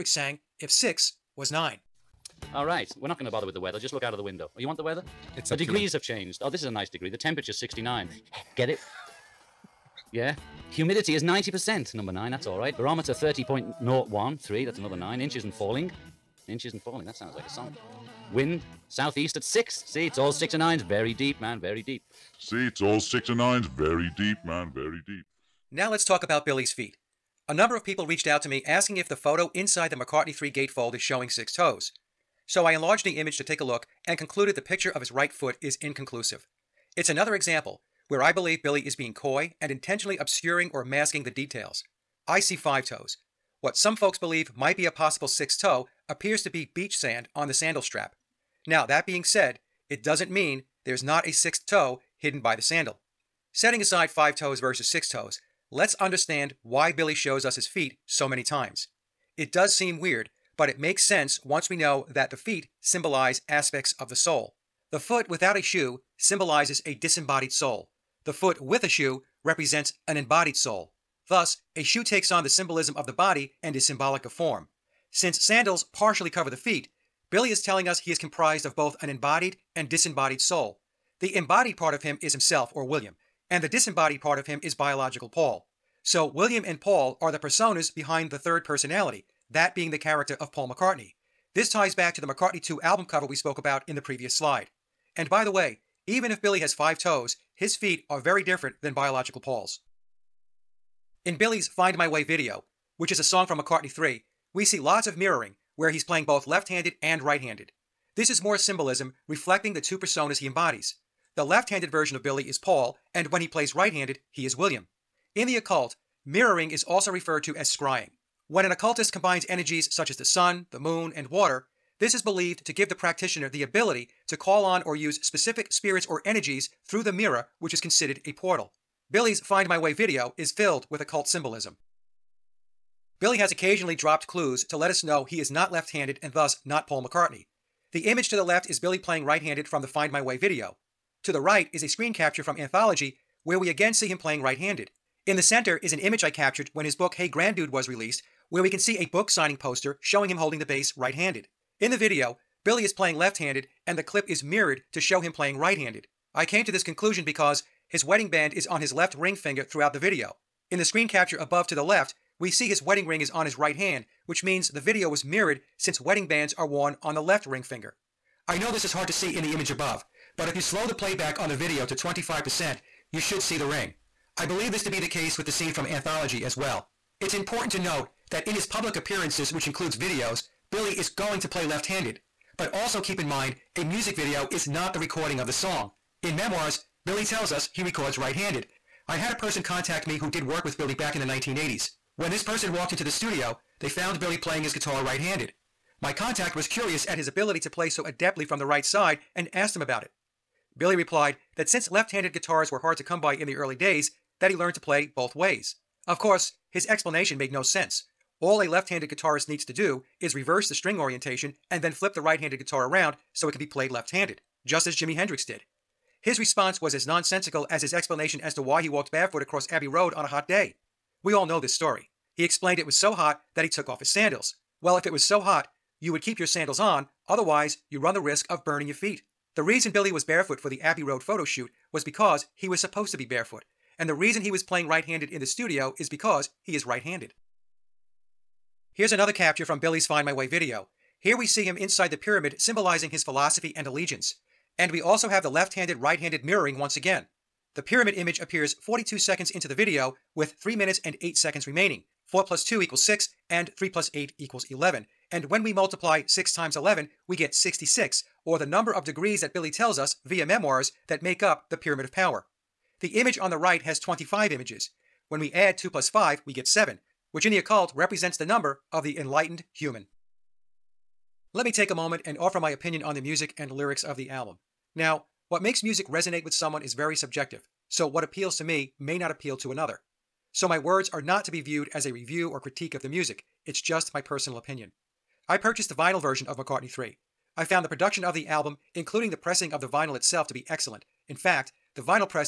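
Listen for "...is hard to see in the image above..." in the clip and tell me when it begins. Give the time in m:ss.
2:48.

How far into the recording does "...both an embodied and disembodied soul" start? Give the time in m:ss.
1:18.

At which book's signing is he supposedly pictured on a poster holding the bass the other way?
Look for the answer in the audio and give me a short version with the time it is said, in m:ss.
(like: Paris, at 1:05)
Hey Grandude, at 2:27.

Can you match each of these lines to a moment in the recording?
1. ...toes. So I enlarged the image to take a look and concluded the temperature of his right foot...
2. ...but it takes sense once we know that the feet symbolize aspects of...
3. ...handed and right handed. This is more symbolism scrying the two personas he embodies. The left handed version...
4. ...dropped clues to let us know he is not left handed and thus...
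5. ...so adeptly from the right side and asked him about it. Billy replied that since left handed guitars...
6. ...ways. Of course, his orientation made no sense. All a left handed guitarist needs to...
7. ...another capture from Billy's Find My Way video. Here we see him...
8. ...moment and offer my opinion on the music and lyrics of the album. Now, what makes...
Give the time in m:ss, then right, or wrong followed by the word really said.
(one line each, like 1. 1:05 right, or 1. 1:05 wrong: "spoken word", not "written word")
1. 0:31 wrong: "picture", not "temperature"
2. 1:00 wrong: "makes", not "takes"
3. 1:46 wrong: "reflecting", not "scrying"
4. 2:13 right
5. 3:17 right
6. 3:25 wrong: "explanation", not "orientation"
7. 3:59 right
8. 4:31 right.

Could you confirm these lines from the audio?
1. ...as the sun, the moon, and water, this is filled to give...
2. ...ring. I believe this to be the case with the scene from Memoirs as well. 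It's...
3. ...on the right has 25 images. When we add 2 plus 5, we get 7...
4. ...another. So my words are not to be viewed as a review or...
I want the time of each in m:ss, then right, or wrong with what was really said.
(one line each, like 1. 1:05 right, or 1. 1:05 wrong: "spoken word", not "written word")
1. 2:00 wrong: "believed", not "filled"
2. 2:53 wrong: "Anthology", not "Memoirs"
3. 4:23 right
4. 4:39 right.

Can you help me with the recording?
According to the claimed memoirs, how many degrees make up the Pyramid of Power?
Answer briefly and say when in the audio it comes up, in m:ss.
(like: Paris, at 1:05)
66, at 4:17.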